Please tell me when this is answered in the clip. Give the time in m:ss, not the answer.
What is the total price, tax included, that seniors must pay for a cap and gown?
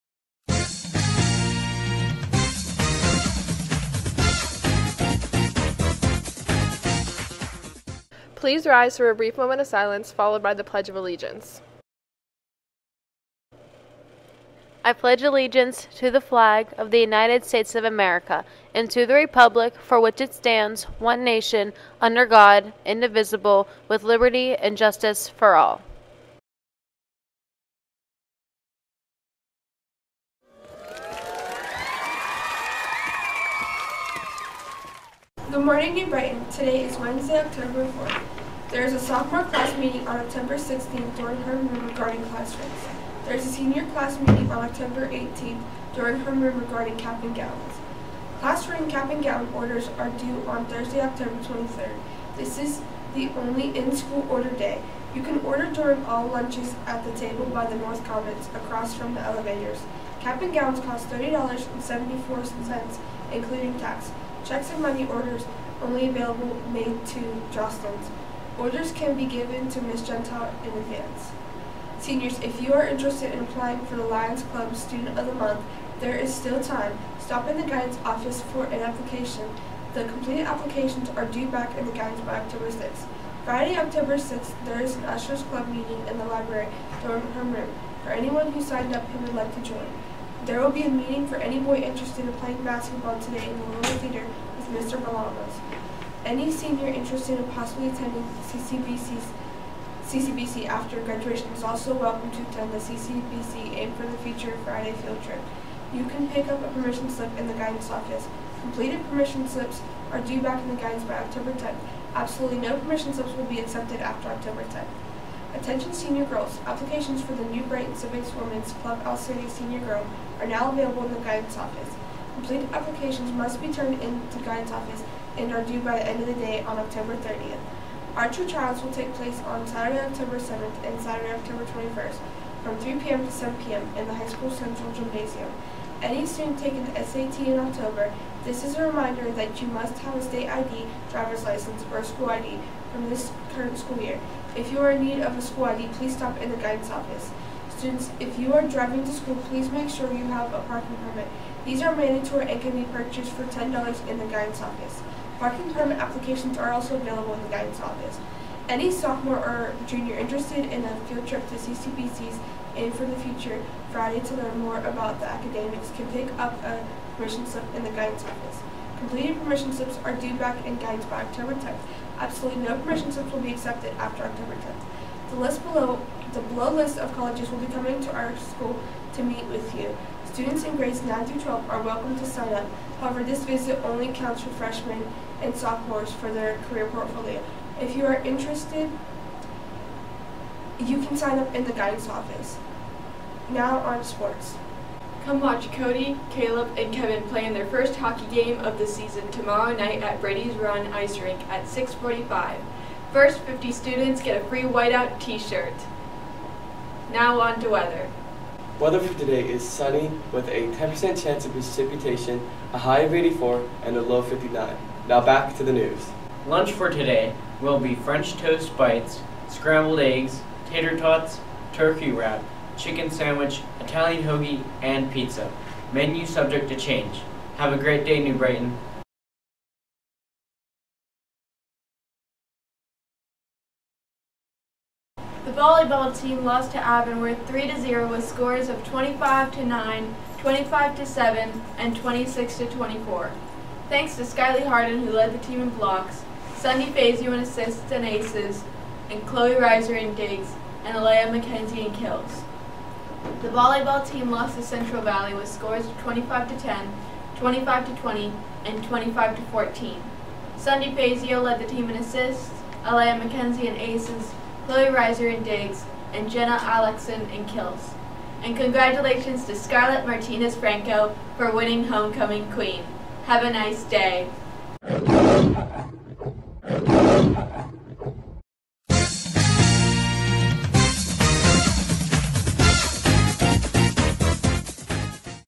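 1:01.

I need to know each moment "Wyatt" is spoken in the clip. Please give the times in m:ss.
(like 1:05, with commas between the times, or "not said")
not said.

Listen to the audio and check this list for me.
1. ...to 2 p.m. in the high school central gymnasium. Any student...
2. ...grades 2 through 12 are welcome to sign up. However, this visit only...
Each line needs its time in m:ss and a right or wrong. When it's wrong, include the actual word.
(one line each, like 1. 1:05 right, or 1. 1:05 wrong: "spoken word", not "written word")
1. 2:13 wrong: "7", not "2"
2. 3:00 wrong: "9", not "2".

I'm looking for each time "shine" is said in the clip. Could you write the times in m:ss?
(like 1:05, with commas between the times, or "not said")
not said.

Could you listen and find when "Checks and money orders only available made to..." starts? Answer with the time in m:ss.
1:04.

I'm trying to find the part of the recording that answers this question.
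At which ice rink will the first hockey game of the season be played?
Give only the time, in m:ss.
3:20.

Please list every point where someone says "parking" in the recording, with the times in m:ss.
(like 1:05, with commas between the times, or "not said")
2:30, 2:35.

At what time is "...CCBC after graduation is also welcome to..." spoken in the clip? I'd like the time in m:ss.
1:40.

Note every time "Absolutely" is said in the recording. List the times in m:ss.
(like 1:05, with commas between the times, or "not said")
1:52, 2:52.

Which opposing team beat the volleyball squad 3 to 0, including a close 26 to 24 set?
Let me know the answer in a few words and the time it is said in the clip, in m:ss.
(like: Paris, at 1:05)
Avonworth, at 3:56.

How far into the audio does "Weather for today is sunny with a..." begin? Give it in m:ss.
3:28.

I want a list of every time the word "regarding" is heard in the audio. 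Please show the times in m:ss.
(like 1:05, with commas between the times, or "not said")
0:41, 0:46.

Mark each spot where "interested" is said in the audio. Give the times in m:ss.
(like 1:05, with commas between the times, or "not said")
1:12, 1:31, 1:36, 2:40, 3:08.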